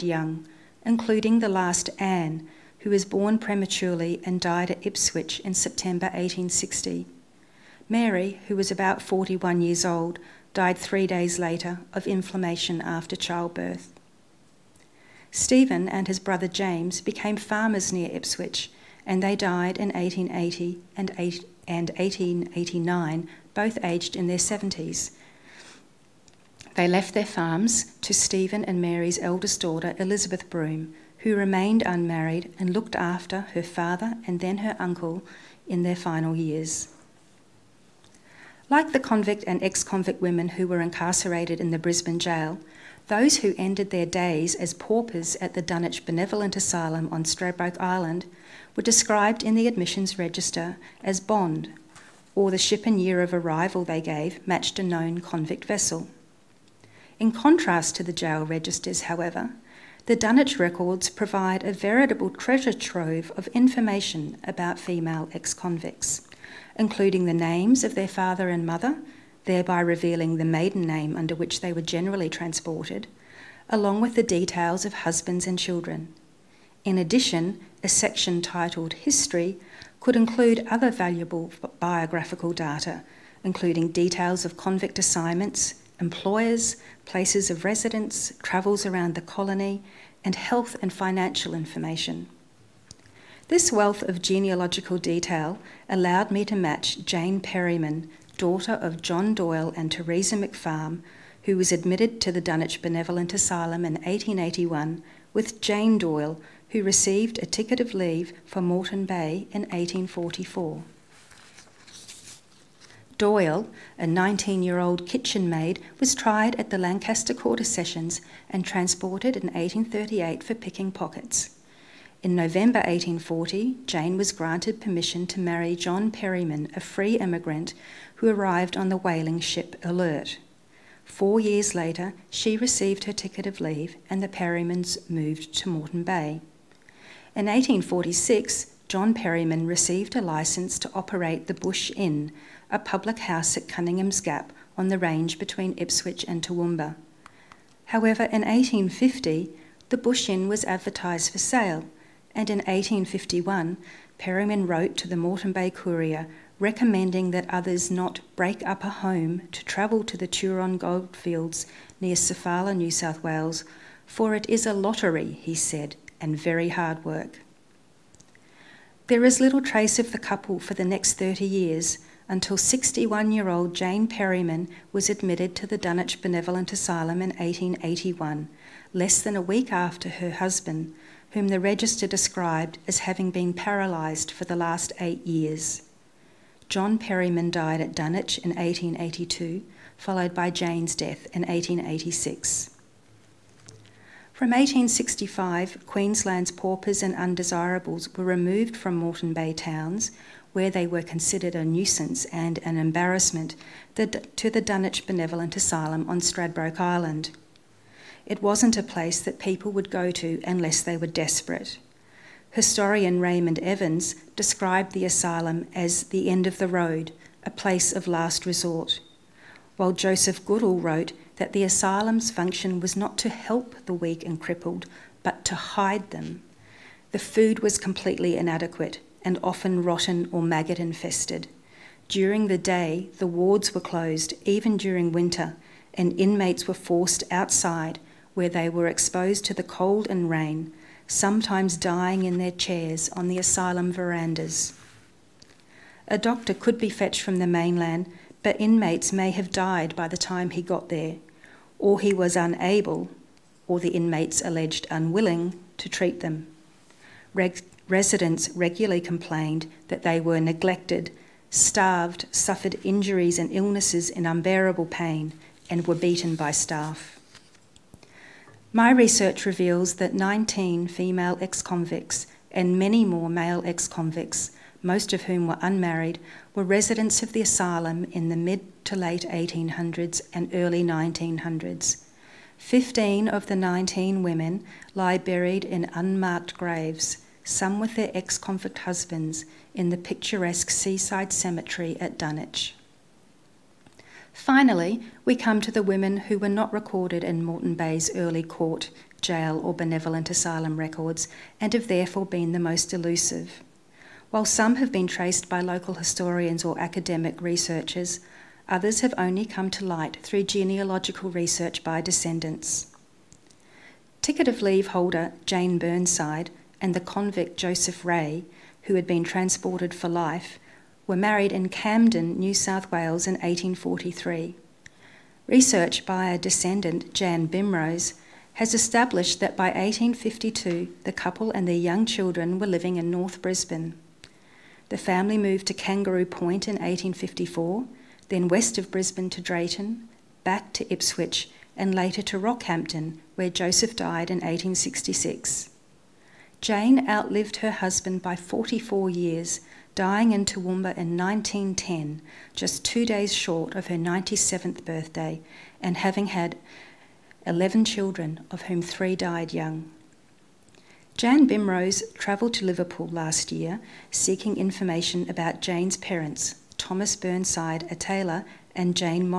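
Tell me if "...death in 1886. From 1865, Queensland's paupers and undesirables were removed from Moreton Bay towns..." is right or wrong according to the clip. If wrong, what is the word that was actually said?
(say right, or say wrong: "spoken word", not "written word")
right.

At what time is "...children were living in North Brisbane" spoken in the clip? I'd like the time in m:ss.
5:32.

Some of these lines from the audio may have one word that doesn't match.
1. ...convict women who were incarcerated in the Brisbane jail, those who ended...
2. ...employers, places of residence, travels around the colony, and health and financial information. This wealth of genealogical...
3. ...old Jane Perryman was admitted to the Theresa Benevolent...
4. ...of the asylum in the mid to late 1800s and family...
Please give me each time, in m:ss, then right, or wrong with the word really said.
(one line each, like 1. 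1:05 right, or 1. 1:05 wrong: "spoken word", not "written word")
1. 0:39 right
2. 1:25 right
3. 2:53 wrong: "Dunwich", not "Theresa"
4. 4:37 wrong: "early", not "family".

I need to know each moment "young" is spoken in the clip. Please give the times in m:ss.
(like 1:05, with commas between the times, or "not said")
0:00, 5:31, 5:59.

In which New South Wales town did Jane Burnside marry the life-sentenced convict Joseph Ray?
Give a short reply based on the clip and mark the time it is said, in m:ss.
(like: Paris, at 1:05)
Camden, at 5:21.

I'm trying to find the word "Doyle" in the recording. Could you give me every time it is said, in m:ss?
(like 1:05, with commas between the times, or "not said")
1:39, 1:45, 1:53.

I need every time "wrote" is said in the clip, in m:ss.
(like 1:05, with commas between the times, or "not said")
2:34, 3:40.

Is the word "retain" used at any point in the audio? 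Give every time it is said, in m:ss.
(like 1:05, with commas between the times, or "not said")
not said.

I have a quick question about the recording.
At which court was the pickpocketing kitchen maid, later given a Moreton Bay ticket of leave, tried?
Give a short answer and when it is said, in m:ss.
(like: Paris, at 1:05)
Lancaster Quarter Sessions, at 1:56.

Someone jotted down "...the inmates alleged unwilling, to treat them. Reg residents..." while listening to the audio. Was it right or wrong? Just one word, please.
right.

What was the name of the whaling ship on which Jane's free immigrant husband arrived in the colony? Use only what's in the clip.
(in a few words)
Alert.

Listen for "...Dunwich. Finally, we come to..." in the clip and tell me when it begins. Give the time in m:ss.
4:52.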